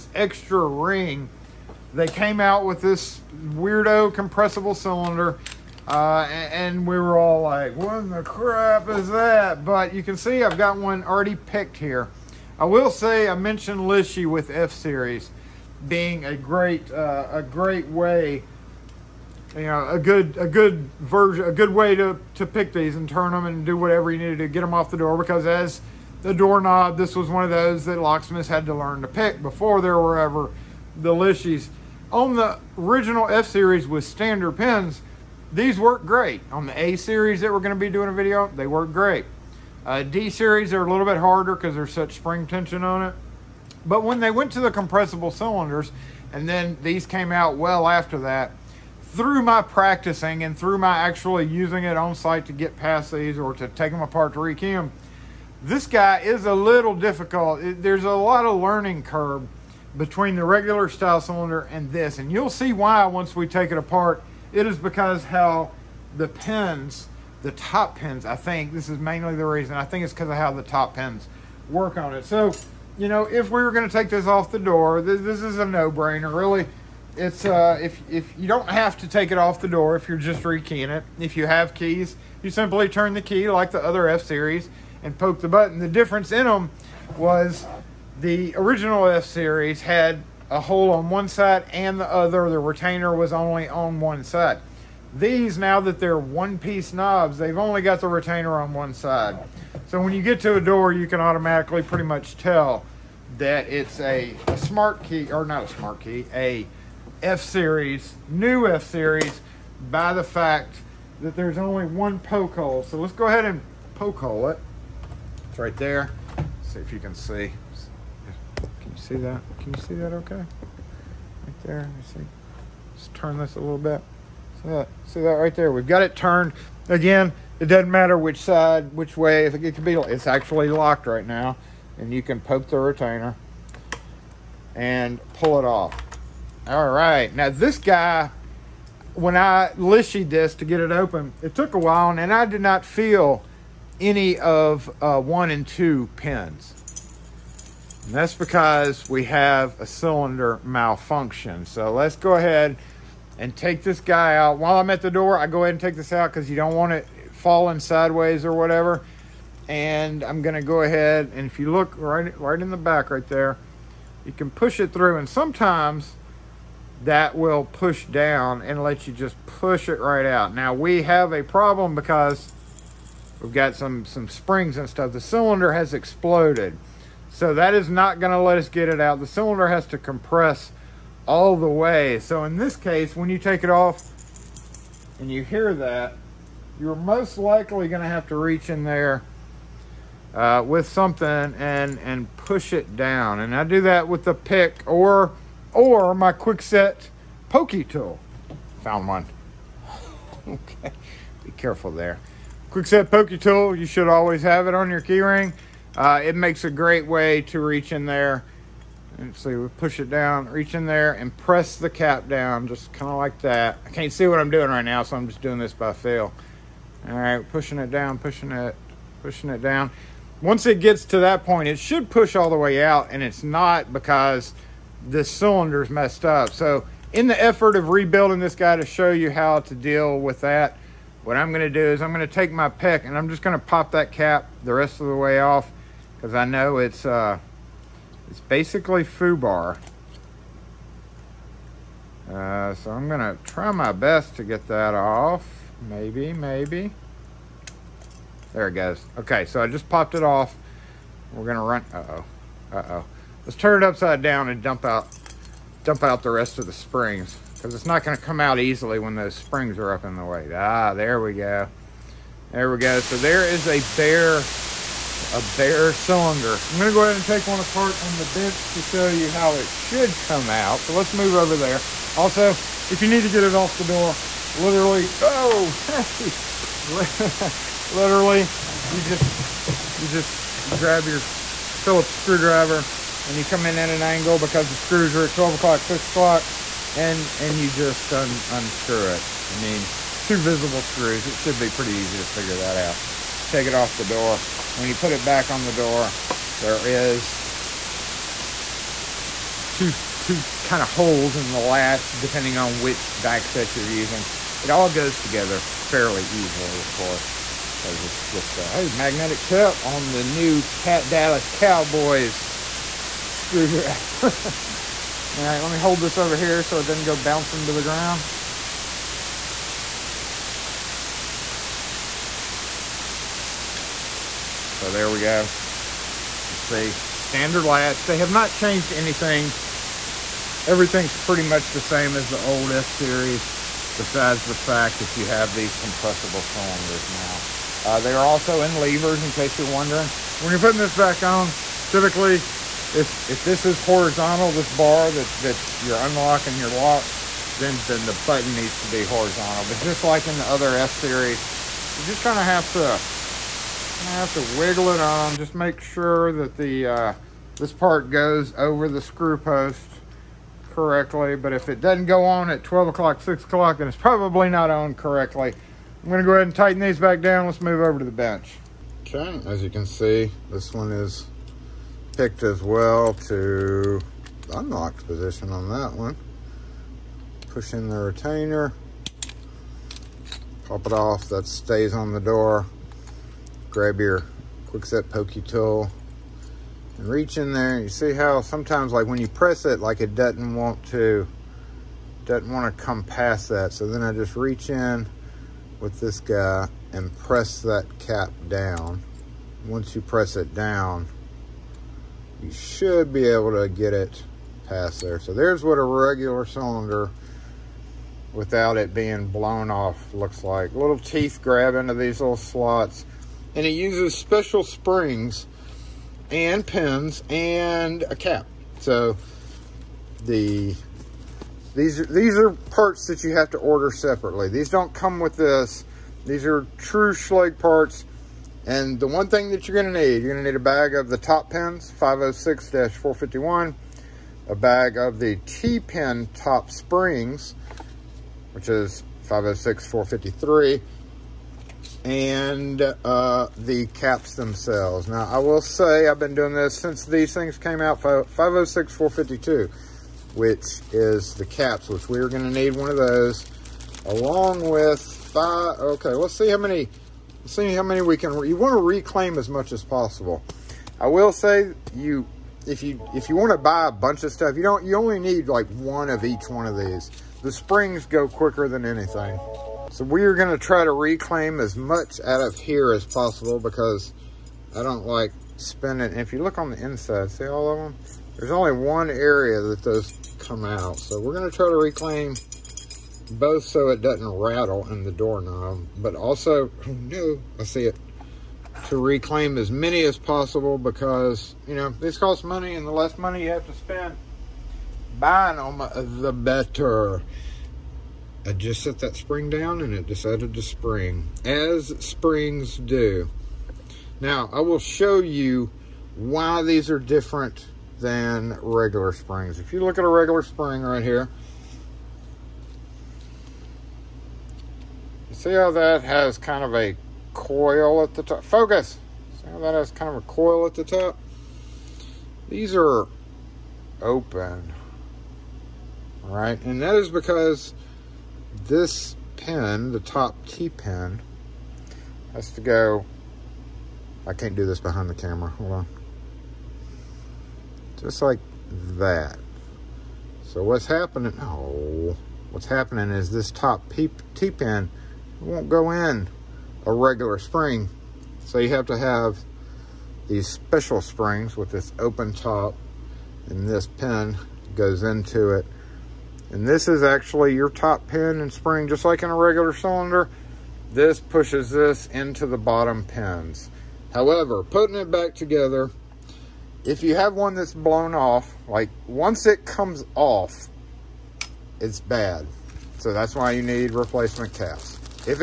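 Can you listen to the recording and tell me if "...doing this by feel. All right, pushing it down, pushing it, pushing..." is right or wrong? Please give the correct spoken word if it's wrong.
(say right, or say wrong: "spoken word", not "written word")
right.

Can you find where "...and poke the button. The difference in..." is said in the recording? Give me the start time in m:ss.
1:25.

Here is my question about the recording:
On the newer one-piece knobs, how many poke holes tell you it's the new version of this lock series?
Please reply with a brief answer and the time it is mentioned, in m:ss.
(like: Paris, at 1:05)
1, at 1:51.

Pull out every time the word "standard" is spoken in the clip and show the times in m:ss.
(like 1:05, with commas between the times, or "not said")
0:34, 5:27.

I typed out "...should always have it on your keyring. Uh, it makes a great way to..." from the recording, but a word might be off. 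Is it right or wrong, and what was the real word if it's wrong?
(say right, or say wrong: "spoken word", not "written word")
right.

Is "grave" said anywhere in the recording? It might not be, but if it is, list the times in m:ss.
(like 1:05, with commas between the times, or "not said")
not said.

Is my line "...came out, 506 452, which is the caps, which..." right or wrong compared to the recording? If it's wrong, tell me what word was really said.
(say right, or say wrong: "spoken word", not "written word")
right.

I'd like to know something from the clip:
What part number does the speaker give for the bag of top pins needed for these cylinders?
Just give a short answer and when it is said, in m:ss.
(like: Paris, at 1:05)
506-451, at 7:11.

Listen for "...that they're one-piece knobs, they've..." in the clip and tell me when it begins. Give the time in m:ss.
1:35.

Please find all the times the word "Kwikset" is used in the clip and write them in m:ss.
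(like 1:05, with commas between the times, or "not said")
3:16, 3:22, 6:24.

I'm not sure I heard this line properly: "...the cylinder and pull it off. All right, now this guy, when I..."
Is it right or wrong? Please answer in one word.
wrong.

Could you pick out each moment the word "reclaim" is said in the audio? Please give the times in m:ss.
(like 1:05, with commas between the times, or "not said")
7:38, 7:50, 8:01, 8:09.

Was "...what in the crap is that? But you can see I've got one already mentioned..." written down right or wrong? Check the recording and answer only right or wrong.
wrong.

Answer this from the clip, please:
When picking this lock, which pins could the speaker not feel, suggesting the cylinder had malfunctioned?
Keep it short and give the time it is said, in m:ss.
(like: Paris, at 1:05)
1 and 2, at 2:25.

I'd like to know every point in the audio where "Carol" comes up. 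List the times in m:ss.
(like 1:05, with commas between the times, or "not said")
not said.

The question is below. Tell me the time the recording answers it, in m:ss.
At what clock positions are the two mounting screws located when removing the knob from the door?
4:45.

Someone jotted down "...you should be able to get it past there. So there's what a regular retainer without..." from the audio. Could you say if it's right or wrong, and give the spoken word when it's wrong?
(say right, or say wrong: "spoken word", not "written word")
wrong: "cylinder", not "retainer".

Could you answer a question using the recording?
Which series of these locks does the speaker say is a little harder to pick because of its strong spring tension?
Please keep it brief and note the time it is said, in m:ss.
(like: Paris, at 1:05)
D series, at 0:40.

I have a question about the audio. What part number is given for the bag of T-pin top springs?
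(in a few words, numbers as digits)
506-453.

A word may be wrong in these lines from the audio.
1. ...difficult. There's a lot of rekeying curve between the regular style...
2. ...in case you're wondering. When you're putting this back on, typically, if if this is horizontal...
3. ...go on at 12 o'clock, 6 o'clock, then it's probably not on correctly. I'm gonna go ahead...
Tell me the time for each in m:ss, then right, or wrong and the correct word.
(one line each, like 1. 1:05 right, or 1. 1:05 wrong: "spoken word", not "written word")
1. 0:56 wrong: "learning", not "rekeying"
2. 5:39 right
3. 6:02 right.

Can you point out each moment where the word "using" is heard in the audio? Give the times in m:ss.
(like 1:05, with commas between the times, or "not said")
0:51, 5:03.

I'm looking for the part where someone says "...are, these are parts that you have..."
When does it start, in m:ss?
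7:02.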